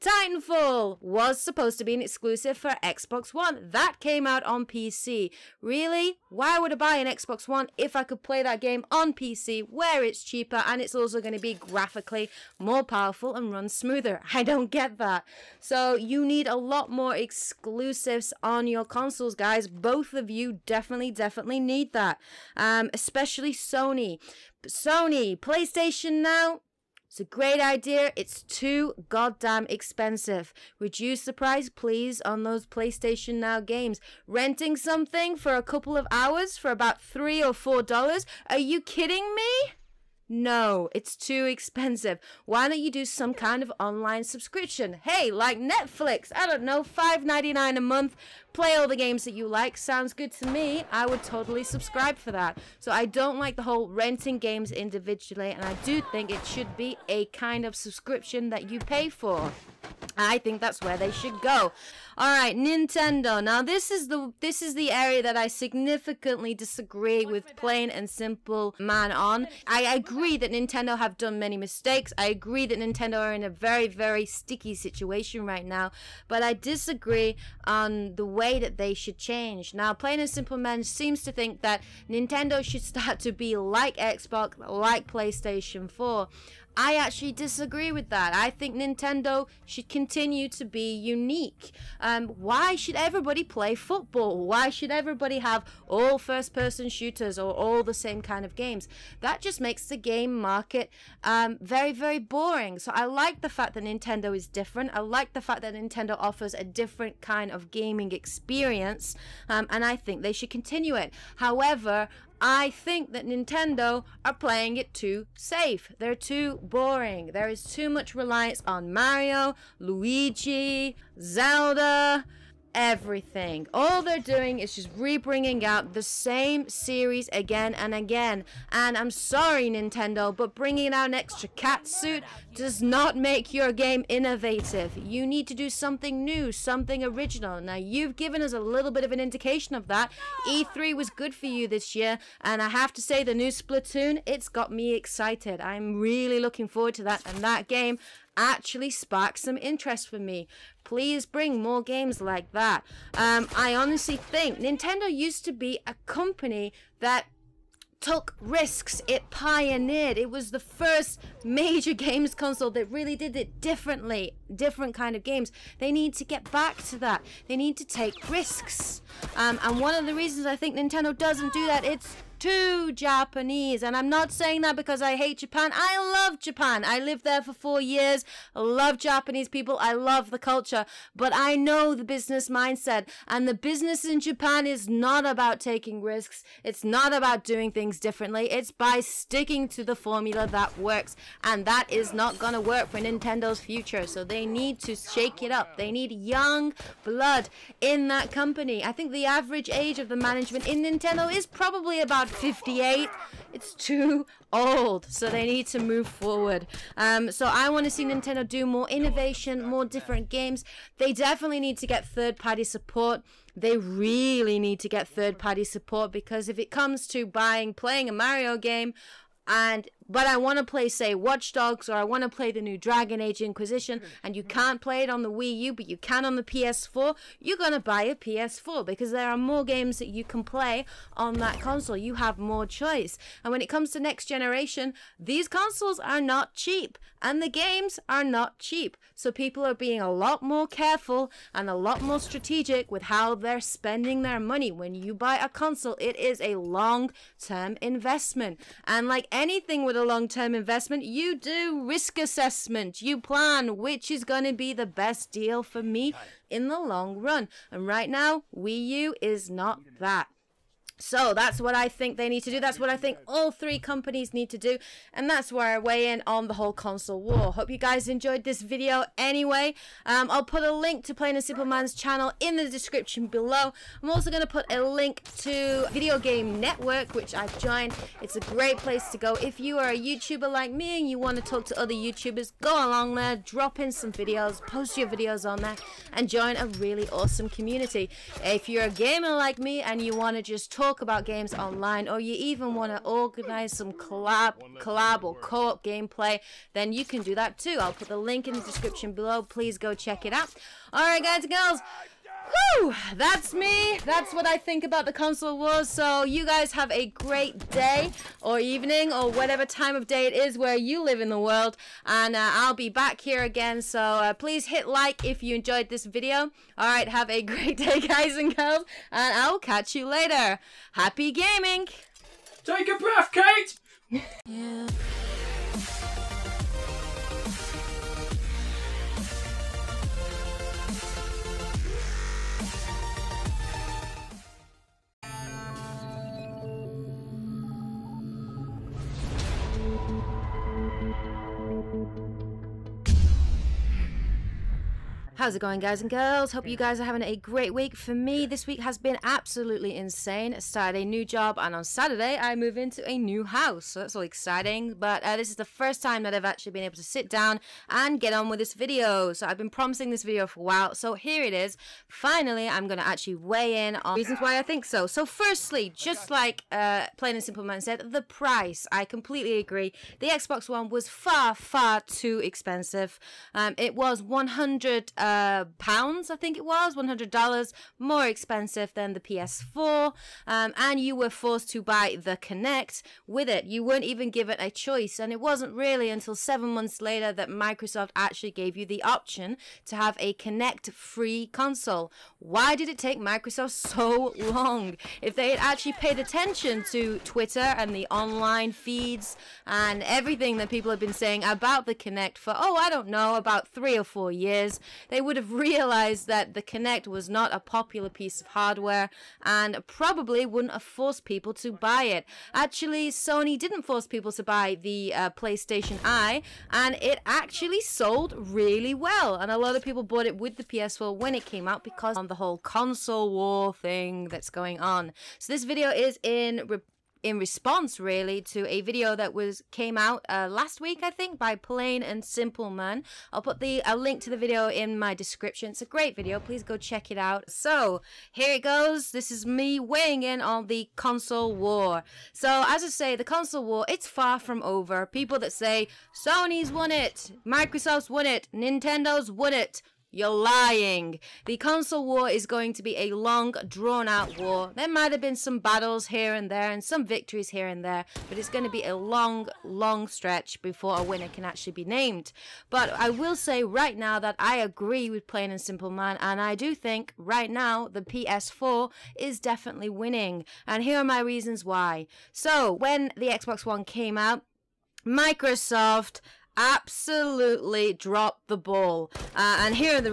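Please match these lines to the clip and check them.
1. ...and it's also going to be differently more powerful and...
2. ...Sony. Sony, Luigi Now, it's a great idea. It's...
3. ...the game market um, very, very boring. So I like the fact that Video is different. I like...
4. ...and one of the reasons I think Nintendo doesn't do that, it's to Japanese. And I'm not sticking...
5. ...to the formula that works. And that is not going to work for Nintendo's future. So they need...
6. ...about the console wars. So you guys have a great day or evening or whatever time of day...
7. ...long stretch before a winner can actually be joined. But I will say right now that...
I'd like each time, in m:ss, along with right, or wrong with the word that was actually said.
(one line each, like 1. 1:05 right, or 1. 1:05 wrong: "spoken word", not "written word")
1. 0:10 wrong: "graphically", not "differently"
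2. 0:23 wrong: "PlayStation", not "Luigi"
3. 1:39 wrong: "Nintendo", not "Video"
4. 2:49 wrong: "saying", not "sticking"
5. 3:09 right
6. 5:04 right
7. 7:39 wrong: "named", not "joined".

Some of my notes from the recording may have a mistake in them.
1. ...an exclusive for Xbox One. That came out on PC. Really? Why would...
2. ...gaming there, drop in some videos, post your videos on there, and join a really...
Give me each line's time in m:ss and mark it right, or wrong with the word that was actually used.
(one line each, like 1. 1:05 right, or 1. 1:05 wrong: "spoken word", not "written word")
1. 0:01 right
2. 4:42 wrong: "along", not "gaming".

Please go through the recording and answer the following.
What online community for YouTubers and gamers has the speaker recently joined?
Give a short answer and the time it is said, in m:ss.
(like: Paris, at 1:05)
Video Game Network, at 4:35.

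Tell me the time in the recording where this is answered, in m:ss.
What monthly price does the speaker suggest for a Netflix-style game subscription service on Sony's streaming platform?
0:46.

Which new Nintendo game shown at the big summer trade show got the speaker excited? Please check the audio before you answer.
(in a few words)
Splatoon.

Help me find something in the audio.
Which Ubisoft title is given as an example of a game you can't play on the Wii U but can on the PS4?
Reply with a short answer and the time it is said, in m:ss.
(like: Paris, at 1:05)
Watch Dogs, at 3:41.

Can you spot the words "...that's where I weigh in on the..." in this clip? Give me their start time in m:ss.
4:25.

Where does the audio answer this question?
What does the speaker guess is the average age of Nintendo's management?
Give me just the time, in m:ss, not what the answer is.
3:22.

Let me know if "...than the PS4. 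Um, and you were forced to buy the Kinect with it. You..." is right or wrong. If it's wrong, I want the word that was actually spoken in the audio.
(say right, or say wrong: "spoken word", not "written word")
right.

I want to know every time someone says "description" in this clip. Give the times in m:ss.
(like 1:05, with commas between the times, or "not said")
4:32, 4:58, 7:15.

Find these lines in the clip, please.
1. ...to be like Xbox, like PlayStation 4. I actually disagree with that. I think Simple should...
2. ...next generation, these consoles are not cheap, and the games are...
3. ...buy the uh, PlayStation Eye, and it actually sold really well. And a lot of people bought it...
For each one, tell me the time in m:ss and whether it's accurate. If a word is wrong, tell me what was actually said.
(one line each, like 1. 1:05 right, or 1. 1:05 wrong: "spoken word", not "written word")
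1. 1:23 wrong: "Nintendo", not "Simple"
2. 3:53 right
3. 6:54 right.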